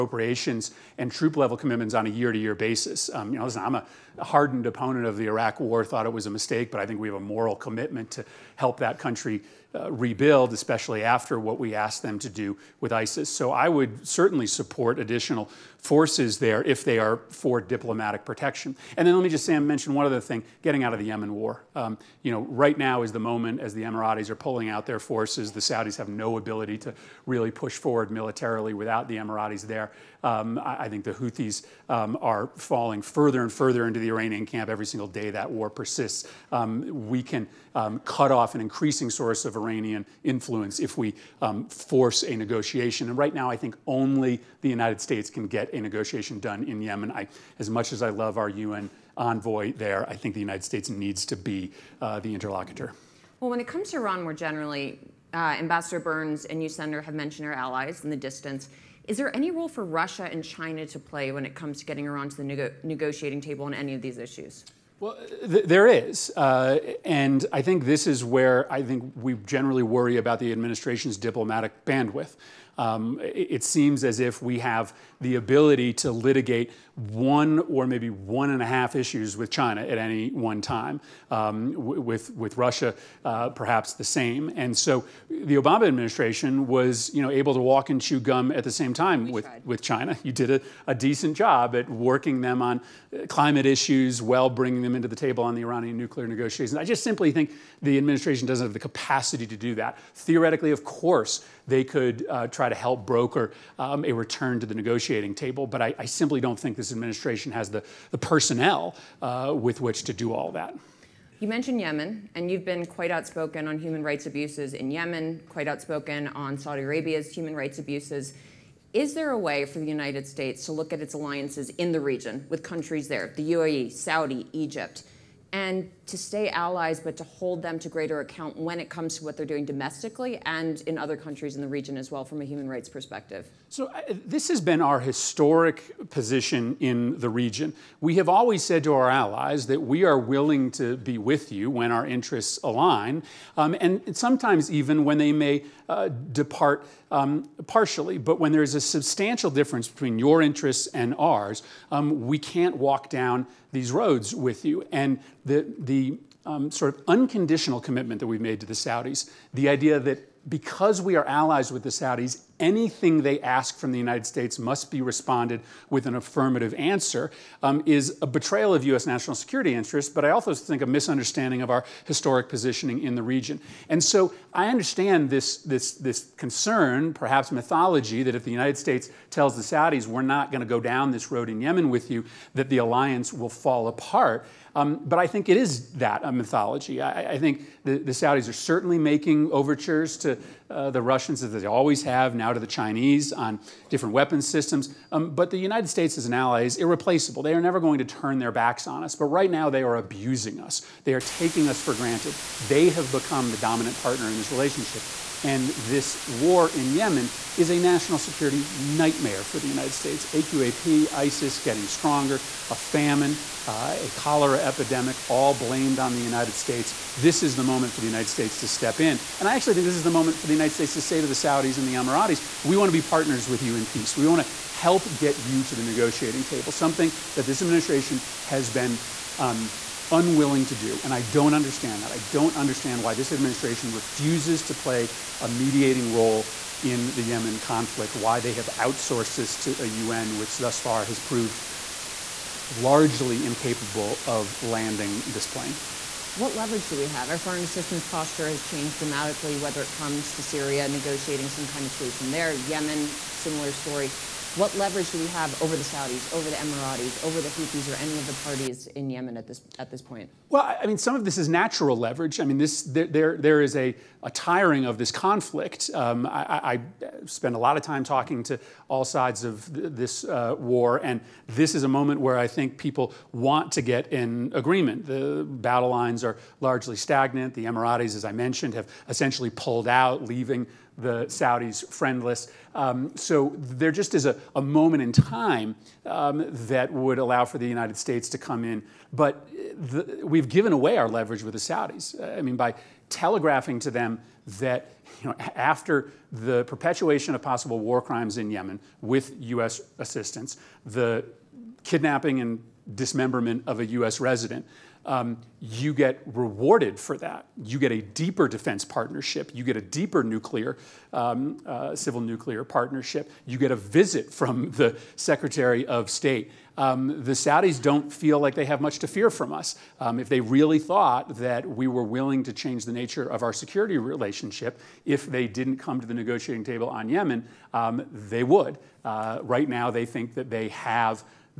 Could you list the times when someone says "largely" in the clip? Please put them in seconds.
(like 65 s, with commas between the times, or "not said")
242 s, 276 s.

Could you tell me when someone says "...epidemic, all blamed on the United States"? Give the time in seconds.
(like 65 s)
214 s.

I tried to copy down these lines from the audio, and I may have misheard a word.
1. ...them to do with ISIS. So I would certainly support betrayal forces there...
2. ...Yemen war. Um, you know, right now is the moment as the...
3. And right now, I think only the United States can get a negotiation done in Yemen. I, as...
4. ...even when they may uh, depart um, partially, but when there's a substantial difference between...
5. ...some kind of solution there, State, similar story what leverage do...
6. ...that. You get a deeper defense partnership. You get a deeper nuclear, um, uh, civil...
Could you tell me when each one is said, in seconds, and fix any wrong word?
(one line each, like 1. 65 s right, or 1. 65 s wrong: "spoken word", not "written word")
1. 12 s wrong: "additional", not "betrayal"
2. 21 s right
3. 43 s right
4. 144 s right
5. 251 s wrong: "Yemen", not "State"
6. 307 s right.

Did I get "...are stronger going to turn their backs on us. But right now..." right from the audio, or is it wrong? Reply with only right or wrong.
wrong.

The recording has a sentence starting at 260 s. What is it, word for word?
Well, I mean, some of this is natural leverage.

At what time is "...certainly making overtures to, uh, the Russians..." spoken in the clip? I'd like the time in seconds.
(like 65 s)
188 s.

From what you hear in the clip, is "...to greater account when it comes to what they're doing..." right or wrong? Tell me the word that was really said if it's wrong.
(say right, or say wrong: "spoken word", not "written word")
right.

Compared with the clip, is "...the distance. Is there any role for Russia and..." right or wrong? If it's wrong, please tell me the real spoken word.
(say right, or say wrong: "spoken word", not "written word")
right.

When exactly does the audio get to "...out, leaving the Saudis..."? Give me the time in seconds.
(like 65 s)
279 s.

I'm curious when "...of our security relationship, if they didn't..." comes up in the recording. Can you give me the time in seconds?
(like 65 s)
323 s.